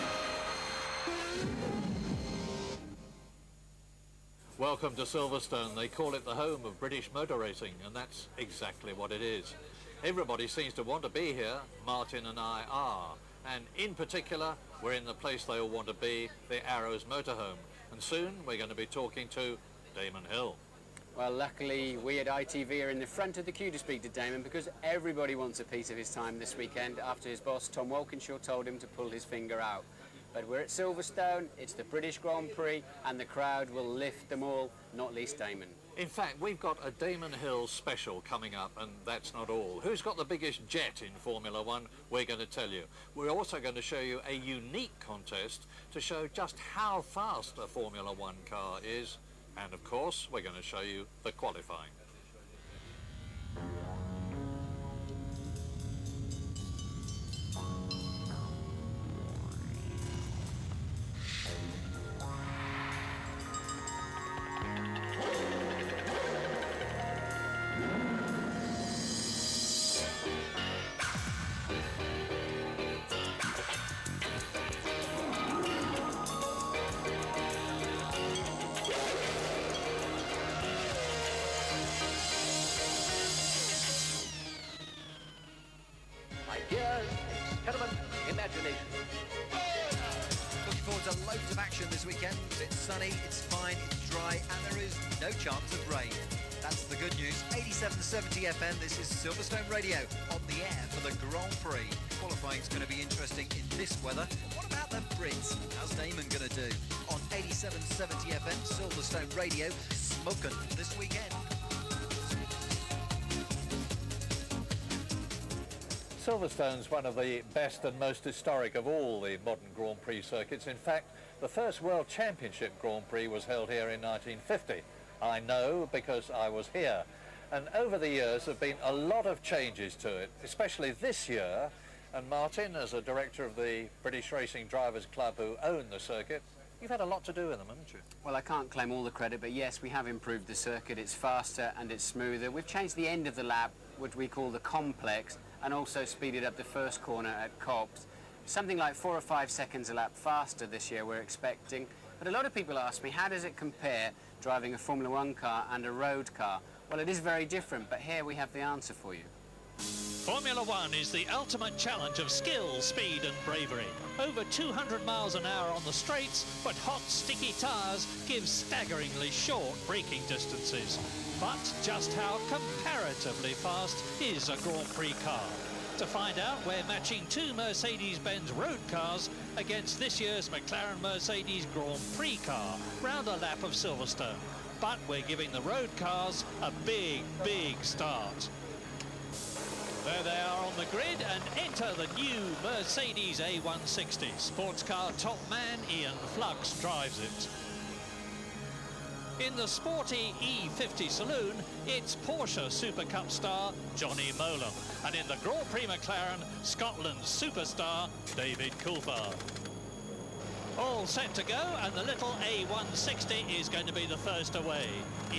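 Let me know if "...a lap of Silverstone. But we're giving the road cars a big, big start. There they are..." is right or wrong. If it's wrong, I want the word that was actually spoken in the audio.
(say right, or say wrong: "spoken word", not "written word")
right.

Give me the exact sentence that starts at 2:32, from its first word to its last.
But a lot of people ask me, how does it compare driving a Formula One car and a road car?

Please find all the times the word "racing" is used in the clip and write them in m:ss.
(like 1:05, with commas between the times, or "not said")
0:07, 2:14.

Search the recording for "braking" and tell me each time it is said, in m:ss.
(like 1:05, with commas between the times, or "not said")
2:49.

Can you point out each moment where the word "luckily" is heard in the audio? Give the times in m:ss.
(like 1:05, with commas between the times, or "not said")
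0:21.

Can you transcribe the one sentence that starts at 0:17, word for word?
And soon we're going to be talking to Damon Hill.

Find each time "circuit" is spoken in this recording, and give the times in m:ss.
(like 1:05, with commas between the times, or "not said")
2:00, 2:15, 2:20.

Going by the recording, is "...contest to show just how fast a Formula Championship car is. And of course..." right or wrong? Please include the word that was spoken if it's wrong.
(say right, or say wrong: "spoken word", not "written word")
wrong: "One", not "Championship".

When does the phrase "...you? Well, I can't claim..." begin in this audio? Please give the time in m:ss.
2:17.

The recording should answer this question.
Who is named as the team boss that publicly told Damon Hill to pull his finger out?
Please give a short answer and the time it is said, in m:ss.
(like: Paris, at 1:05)
Tom Walkinshaw, at 0:27.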